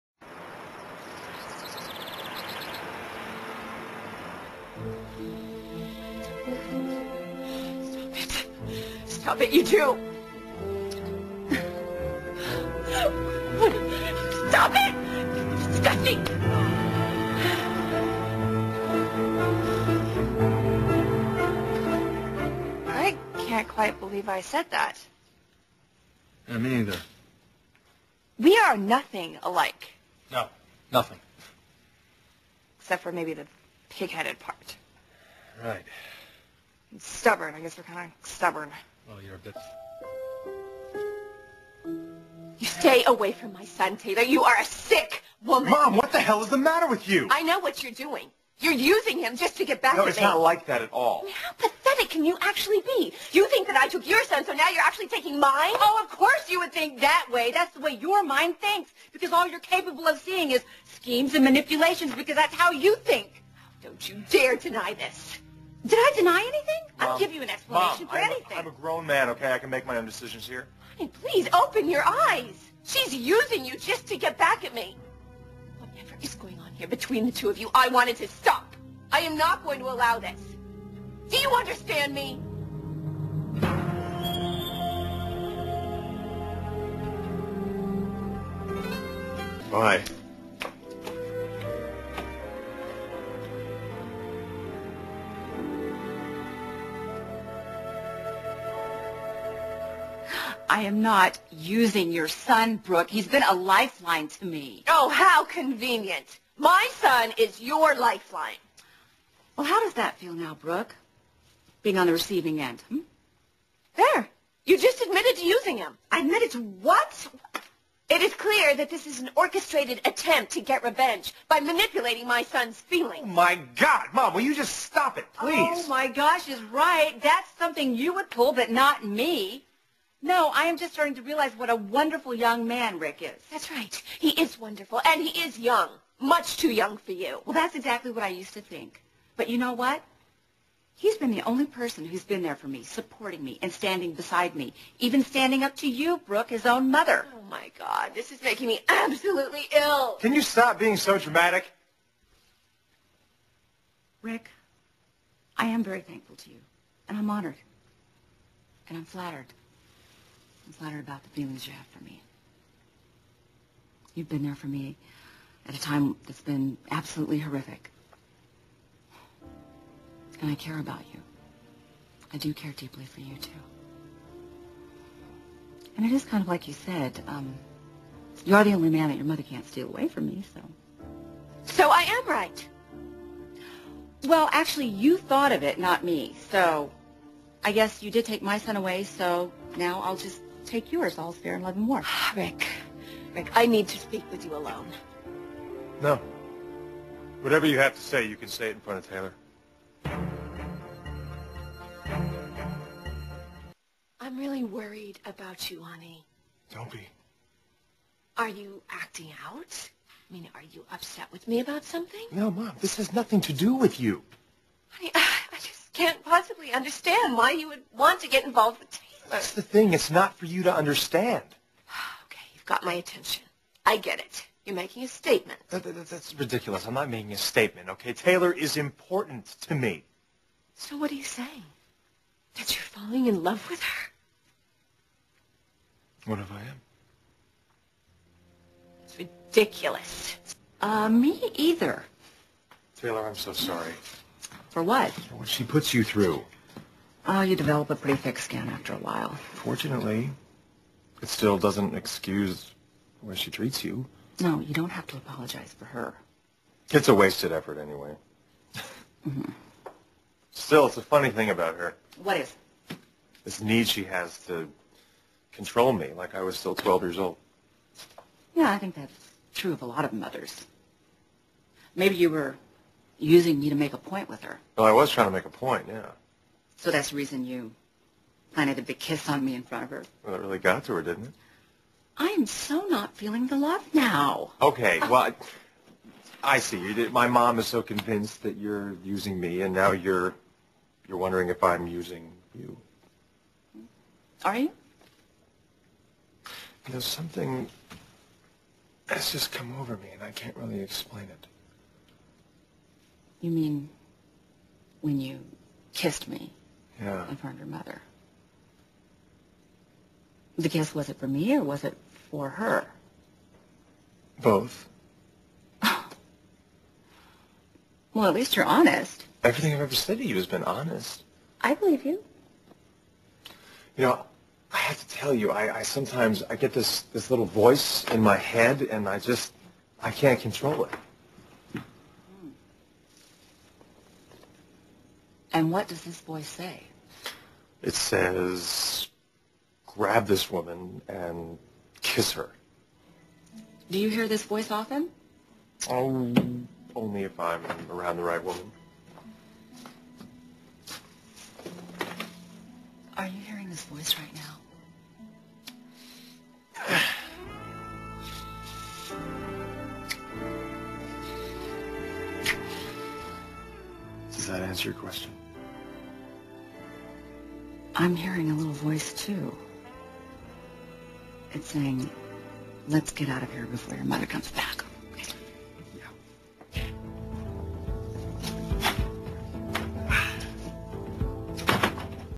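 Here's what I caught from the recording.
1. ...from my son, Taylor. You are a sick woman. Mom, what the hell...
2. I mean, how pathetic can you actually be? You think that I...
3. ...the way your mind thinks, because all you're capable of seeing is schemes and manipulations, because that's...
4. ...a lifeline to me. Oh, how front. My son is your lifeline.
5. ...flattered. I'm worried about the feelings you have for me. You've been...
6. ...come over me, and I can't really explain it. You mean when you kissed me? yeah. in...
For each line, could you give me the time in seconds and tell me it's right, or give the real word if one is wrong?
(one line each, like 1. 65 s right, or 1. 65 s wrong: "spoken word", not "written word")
1. 43 s right
2. 51 s right
3. 57 s right
4. 103 s wrong: "convenient", not "front"
5. 159 s wrong: "flattered", not "worried"
6. 299 s right.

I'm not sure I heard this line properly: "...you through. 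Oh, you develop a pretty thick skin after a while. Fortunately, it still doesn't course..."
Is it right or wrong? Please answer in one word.
wrong.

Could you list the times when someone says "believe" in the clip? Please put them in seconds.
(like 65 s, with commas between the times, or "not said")
23 s, 321 s.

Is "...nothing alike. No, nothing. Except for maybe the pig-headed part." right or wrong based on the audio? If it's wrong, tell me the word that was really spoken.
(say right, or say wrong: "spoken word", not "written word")
right.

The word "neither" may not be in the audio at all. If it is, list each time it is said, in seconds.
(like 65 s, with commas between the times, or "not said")
26 s.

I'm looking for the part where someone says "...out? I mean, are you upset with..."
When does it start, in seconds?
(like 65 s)
209 s.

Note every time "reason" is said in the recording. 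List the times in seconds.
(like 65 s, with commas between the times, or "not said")
277 s.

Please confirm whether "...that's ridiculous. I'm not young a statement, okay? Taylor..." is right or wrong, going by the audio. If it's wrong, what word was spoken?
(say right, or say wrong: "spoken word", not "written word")
wrong: "making", not "young".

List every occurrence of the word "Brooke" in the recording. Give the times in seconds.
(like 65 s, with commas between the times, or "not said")
102 s, 110 s, 146 s.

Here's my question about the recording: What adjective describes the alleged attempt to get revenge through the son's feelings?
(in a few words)
orchestrated.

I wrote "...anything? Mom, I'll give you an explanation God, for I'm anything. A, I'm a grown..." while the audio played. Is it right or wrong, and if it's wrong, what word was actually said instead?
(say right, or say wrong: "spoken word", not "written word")
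wrong: "Mom", not "God".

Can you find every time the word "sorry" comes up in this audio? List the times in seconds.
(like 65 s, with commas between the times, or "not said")
243 s.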